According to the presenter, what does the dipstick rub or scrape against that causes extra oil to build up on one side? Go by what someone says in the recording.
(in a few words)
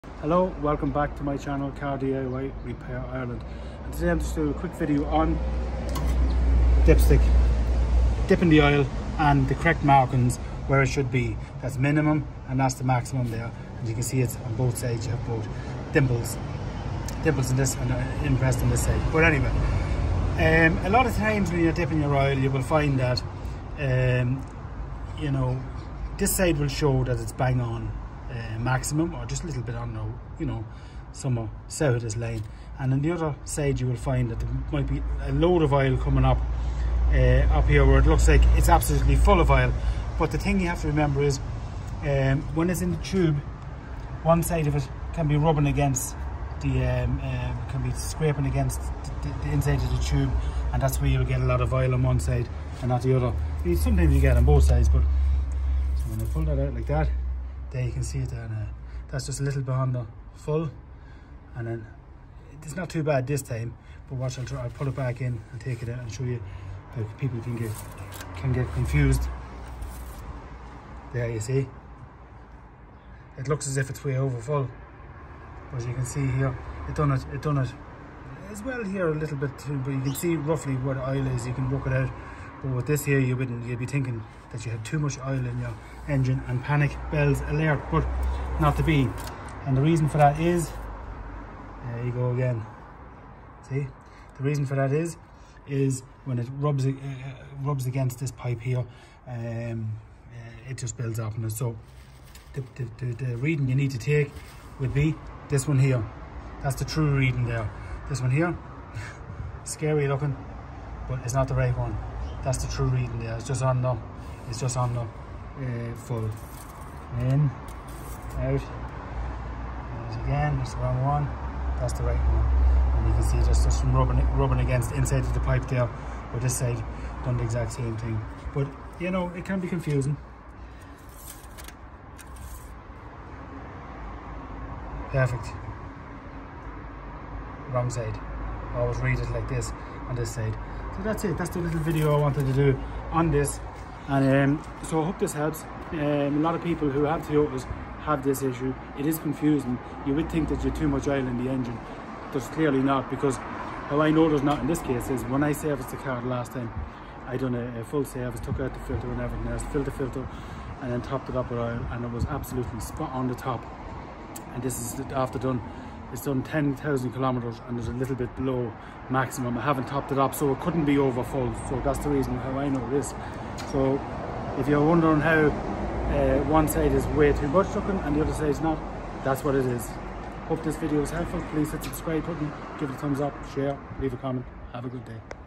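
The inside of the tube.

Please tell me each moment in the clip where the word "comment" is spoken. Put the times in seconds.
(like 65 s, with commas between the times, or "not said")
184 s.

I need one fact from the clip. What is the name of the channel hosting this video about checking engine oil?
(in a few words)
Car DIY Repair Ireland.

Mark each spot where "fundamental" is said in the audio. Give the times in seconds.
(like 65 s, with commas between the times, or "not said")
not said.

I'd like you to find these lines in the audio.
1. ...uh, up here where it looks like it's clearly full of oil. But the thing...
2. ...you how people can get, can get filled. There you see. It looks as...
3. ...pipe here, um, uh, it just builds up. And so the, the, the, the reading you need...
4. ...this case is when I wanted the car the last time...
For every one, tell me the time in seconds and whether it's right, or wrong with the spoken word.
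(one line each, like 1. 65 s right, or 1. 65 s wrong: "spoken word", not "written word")
1. 37 s wrong: "absolutely", not "clearly"
2. 66 s wrong: "confused", not "filled"
3. 98 s right
4. 154 s wrong: "serviced", not "wanted".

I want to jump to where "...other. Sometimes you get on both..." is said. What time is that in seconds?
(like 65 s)
53 s.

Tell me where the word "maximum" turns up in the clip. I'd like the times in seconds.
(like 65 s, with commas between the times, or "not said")
12 s, 28 s, 169 s.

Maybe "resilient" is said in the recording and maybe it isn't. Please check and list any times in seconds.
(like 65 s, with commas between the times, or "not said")
not said.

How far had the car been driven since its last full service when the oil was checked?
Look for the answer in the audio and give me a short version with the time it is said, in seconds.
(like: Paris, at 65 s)
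10,000 kilometers, at 166 s.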